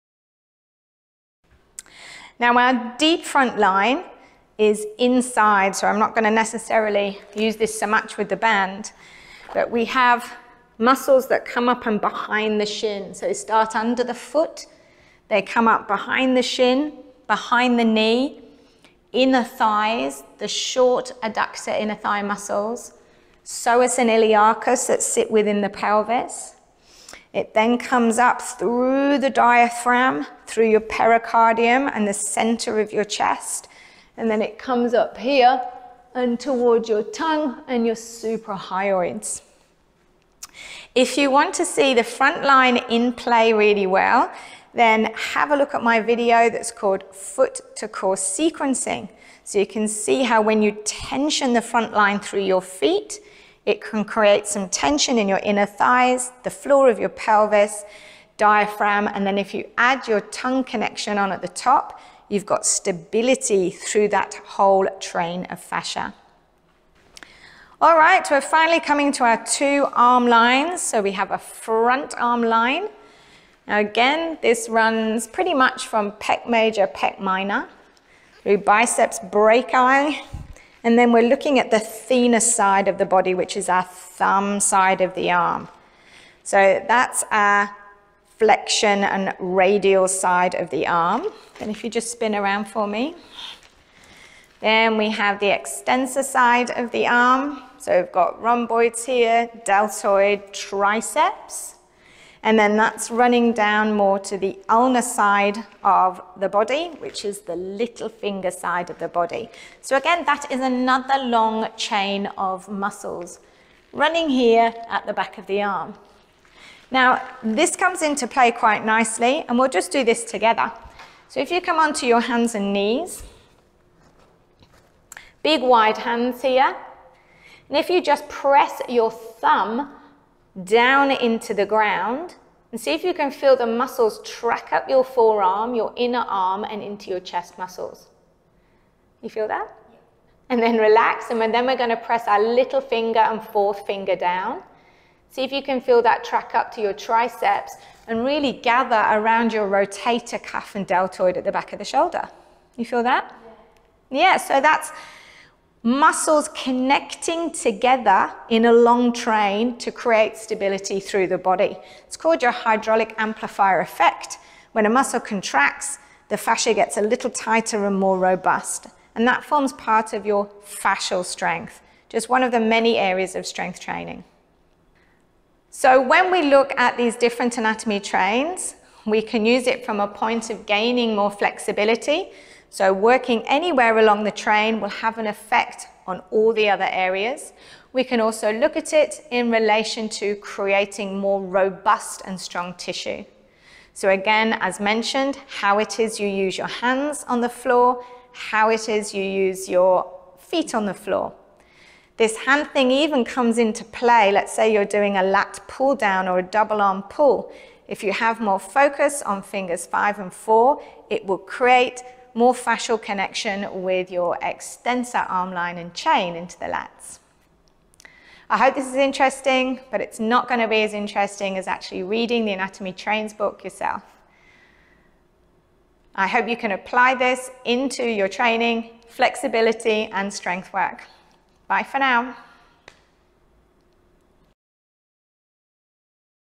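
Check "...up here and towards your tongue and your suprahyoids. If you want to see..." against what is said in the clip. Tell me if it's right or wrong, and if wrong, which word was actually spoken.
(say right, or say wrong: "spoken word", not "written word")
right.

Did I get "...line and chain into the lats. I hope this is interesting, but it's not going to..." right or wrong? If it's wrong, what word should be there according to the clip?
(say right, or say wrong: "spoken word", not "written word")
right.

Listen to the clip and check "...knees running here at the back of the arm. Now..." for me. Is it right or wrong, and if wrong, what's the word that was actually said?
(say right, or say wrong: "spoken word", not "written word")
wrong: "muscles", not "knees".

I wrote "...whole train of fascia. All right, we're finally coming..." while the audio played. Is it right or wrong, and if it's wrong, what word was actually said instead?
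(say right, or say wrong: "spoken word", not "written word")
right.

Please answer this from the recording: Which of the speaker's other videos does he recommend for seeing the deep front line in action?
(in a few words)
Foot to core sequencing.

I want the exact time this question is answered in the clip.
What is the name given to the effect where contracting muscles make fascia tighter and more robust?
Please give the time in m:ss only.
2:42.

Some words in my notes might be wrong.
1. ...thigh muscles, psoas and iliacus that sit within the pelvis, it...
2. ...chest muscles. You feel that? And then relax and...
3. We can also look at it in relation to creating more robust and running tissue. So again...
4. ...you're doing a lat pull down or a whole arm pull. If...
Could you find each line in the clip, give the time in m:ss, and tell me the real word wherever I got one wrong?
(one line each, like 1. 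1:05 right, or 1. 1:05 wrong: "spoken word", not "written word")
1. 0:21 right
2. 2:17 right
3. 3:07 wrong: "strong", not "running"
4. 3:24 wrong: "double", not "whole".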